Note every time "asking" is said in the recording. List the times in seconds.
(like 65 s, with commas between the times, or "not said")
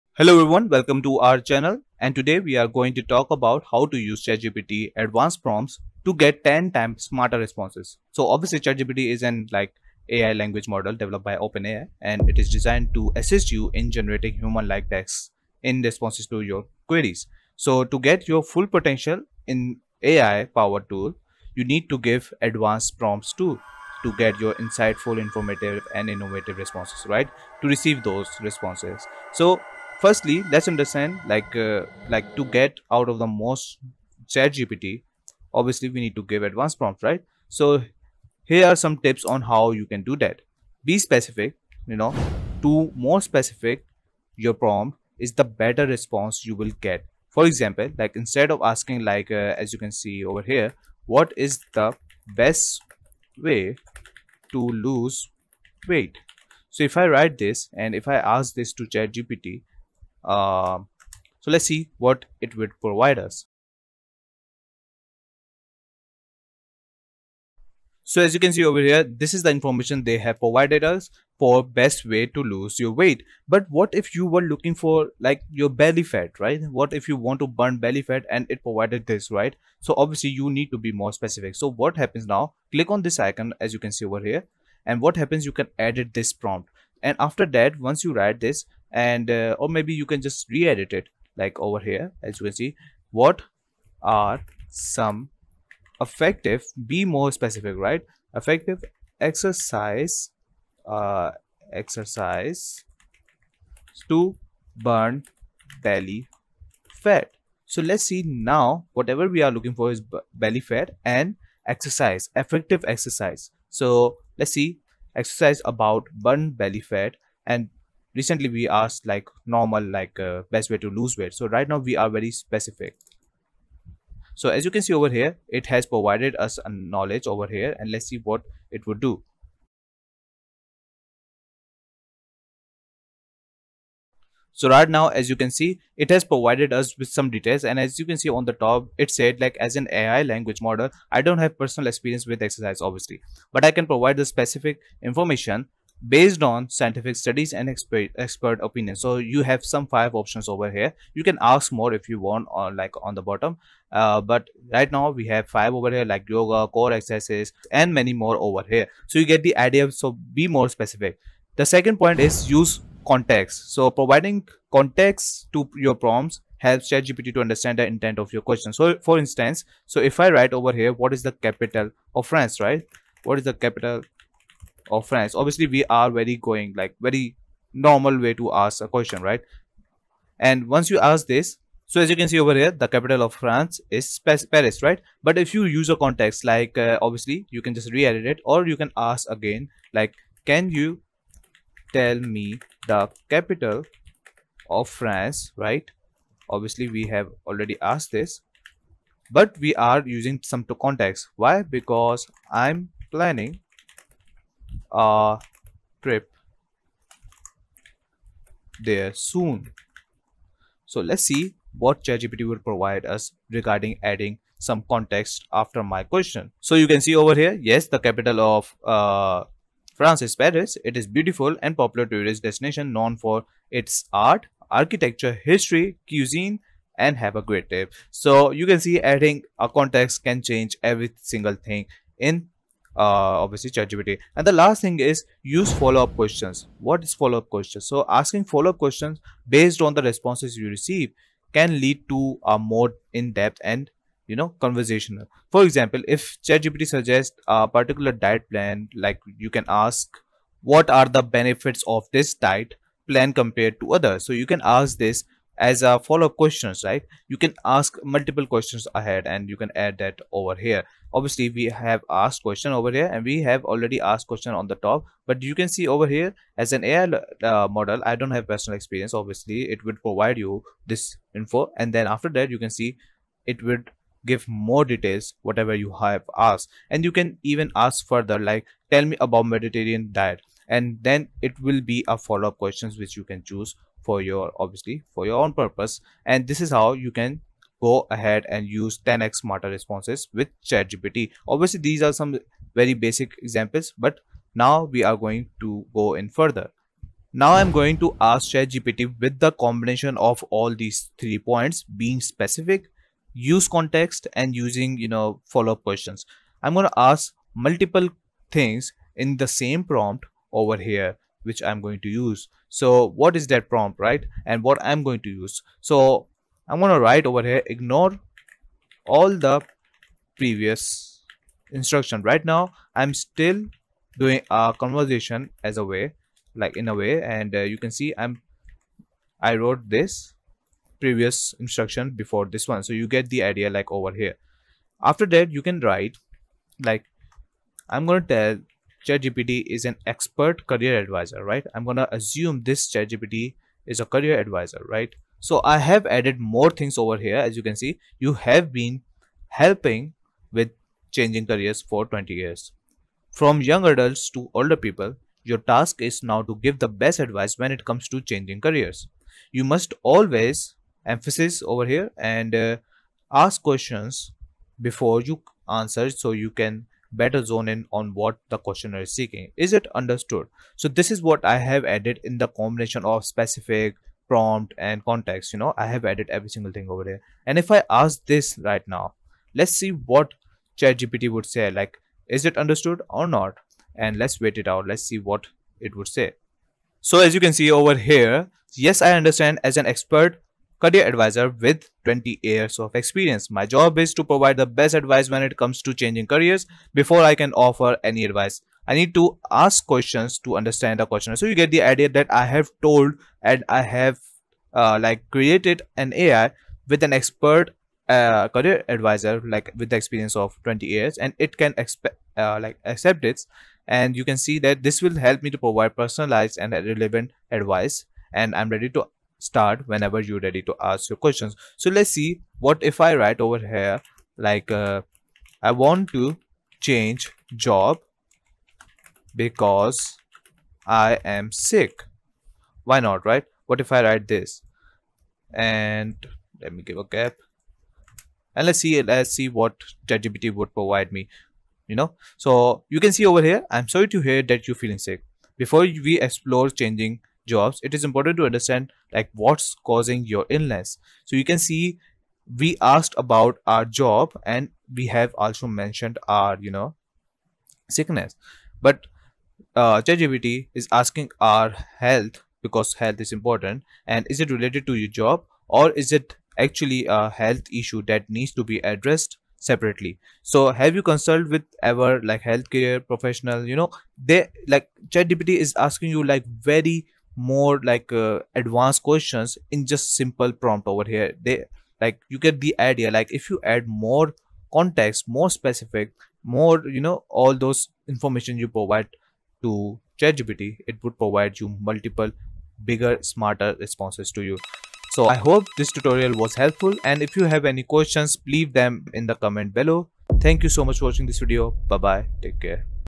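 48 s, 238 s, 460 s, 475 s.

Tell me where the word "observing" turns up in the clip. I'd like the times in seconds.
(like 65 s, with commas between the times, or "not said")
not said.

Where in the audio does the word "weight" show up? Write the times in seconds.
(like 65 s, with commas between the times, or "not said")
55 s, 72 s, 121 s.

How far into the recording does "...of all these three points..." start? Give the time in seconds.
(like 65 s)
300 s.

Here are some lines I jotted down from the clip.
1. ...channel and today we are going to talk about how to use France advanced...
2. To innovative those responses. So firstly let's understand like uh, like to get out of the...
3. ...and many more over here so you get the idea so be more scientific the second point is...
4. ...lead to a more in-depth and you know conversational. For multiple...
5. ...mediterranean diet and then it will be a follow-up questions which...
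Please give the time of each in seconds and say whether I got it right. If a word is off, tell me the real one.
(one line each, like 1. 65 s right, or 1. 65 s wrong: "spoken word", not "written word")
1. 1 s wrong: "ChatGPT", not "France"
2. 27 s wrong: "receive", not "innovative"
3. 157 s wrong: "specific", not "scientific"
4. 241 s wrong: "example", not "multiple"
5. 279 s right.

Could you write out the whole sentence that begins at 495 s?
So I hope this tutorial was helpful and if you have any questions, leave them in the comment below.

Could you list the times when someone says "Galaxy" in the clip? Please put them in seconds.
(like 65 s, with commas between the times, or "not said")
not said.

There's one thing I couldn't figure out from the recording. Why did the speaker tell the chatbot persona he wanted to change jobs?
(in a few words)
because I am sick.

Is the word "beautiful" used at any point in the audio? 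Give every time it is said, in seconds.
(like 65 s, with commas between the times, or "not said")
221 s.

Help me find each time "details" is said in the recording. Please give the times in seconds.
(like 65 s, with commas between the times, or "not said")
137 s, 274 s.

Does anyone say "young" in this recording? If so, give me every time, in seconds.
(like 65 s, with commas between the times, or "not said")
353 s.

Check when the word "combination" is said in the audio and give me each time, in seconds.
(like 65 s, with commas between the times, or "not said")
299 s, 372 s.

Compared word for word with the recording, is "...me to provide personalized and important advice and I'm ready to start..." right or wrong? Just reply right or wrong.
wrong.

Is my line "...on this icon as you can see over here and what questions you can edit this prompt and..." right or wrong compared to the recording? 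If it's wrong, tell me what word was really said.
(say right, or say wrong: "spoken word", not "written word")
wrong: "happens", not "questions".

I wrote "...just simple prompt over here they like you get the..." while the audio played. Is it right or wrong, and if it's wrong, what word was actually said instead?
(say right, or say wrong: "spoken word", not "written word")
right.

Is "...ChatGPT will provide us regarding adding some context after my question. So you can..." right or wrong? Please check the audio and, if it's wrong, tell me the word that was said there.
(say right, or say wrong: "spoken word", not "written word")
right.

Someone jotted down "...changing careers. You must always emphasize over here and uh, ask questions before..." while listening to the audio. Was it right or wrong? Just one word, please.
right.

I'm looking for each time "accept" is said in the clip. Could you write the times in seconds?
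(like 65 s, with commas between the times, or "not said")
412 s.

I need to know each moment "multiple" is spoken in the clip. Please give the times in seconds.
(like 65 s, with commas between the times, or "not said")
258 s, 307 s, 491 s.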